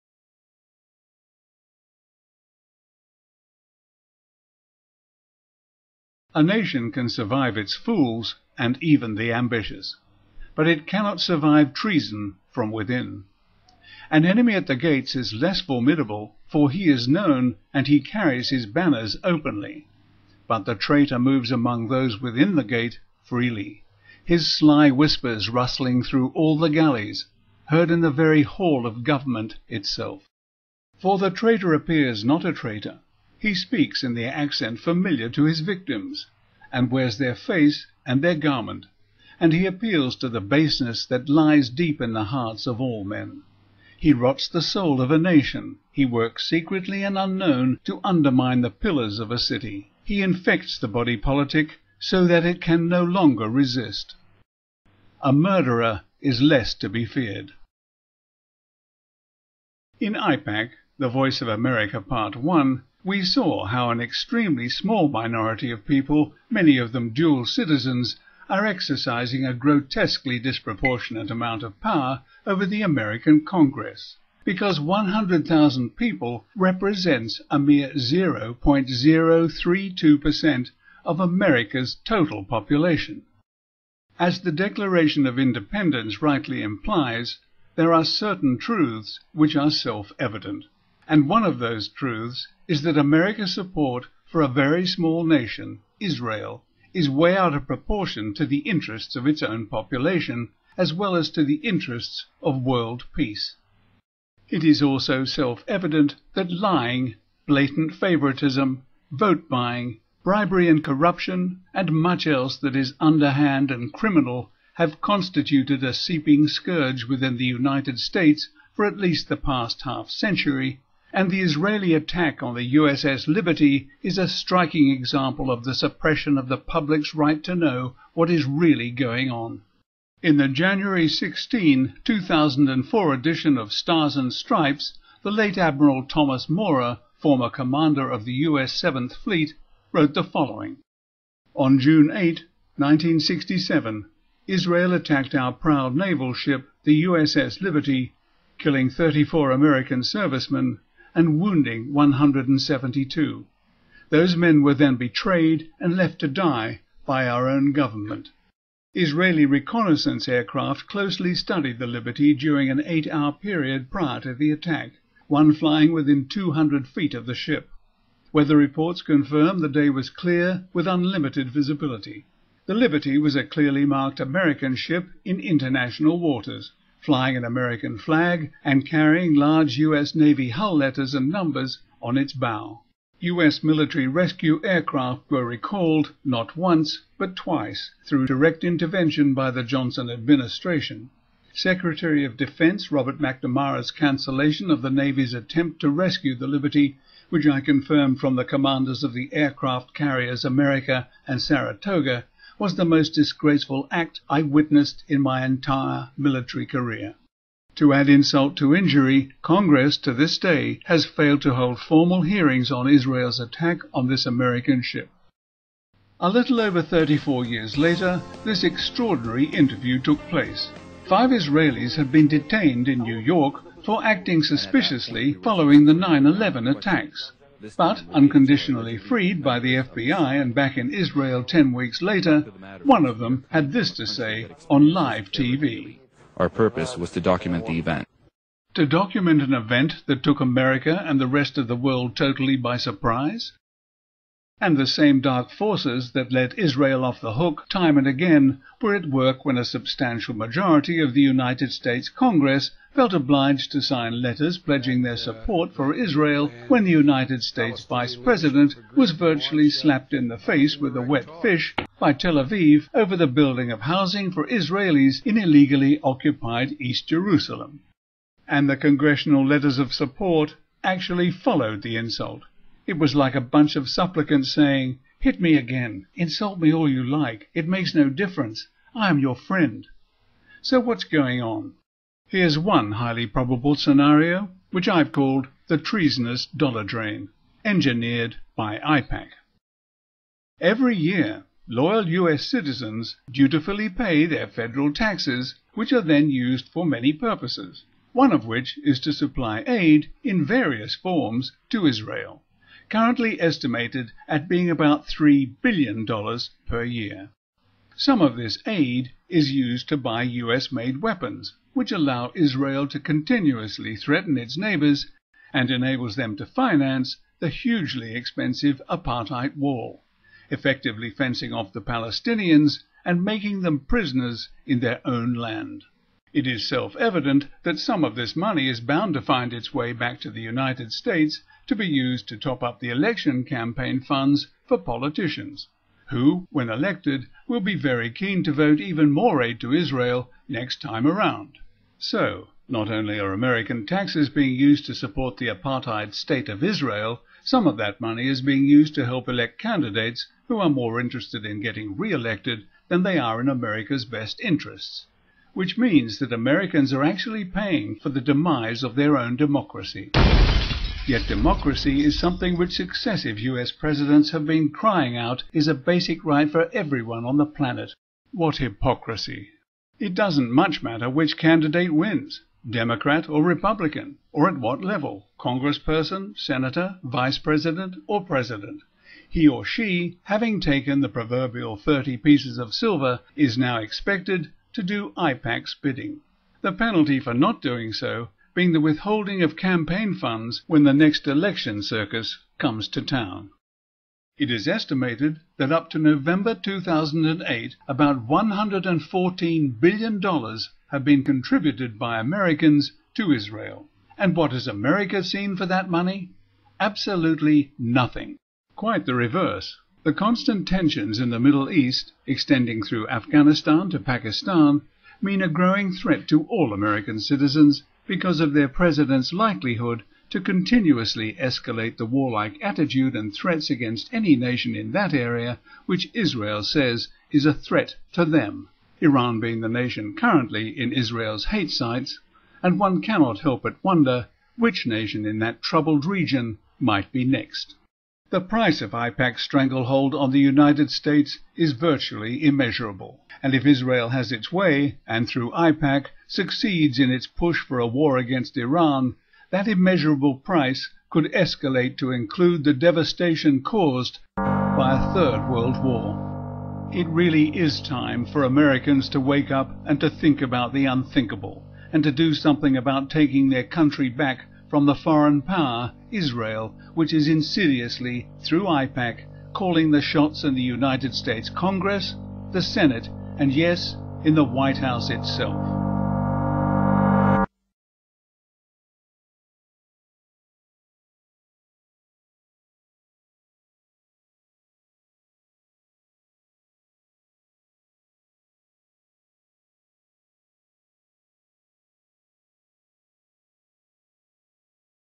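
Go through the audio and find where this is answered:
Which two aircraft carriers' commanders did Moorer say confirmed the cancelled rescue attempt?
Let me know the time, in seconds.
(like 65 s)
200 s.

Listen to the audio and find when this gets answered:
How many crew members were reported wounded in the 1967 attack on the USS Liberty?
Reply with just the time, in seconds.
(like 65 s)
151 s.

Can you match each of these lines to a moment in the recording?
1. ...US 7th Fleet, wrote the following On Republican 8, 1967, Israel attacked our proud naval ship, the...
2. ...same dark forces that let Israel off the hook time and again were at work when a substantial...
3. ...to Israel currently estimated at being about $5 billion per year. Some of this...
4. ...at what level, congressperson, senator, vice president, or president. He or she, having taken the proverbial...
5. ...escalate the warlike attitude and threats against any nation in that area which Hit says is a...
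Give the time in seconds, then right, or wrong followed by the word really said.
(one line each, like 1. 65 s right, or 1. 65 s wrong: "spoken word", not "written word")
1. 138 s wrong: "June", not "Republican"
2. 244 s right
3. 301 s wrong: "3", not "5"
4. 374 s right
5. 421 s wrong: "Israel", not "Hit".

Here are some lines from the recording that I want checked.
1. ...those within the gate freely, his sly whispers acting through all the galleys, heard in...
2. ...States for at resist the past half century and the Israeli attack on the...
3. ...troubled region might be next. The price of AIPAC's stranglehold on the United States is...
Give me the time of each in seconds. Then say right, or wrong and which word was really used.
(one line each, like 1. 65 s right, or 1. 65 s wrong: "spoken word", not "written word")
1. 21 s wrong: "rustling", not "acting"
2. 117 s wrong: "least", not "resist"
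3. 435 s right.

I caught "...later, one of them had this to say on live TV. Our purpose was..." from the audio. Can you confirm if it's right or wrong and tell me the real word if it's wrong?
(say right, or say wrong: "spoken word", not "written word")
right.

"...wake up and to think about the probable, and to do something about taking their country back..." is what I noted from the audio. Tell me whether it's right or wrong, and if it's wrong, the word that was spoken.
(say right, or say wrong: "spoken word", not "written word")
wrong: "unthinkable", not "probable".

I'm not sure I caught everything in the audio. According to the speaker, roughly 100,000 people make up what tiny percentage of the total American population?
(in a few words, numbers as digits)
0.032%.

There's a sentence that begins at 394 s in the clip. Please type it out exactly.
It is estimated that up to November 2008, about $114 billion have been contributed by Americans to Israel.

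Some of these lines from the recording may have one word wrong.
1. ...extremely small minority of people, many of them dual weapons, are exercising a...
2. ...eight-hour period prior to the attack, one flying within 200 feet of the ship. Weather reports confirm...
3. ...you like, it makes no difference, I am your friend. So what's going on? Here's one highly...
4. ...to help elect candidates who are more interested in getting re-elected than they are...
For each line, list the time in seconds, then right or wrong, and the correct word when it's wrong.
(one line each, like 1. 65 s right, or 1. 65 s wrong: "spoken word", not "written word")
1. 63 s wrong: "citizens", not "weapons"
2. 162 s right
3. 276 s right
4. 348 s right.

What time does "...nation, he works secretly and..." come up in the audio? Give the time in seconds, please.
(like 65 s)
45 s.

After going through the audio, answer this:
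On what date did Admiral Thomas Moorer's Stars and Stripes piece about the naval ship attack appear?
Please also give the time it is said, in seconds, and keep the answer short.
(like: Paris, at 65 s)
January 16, 2004, at 130 s.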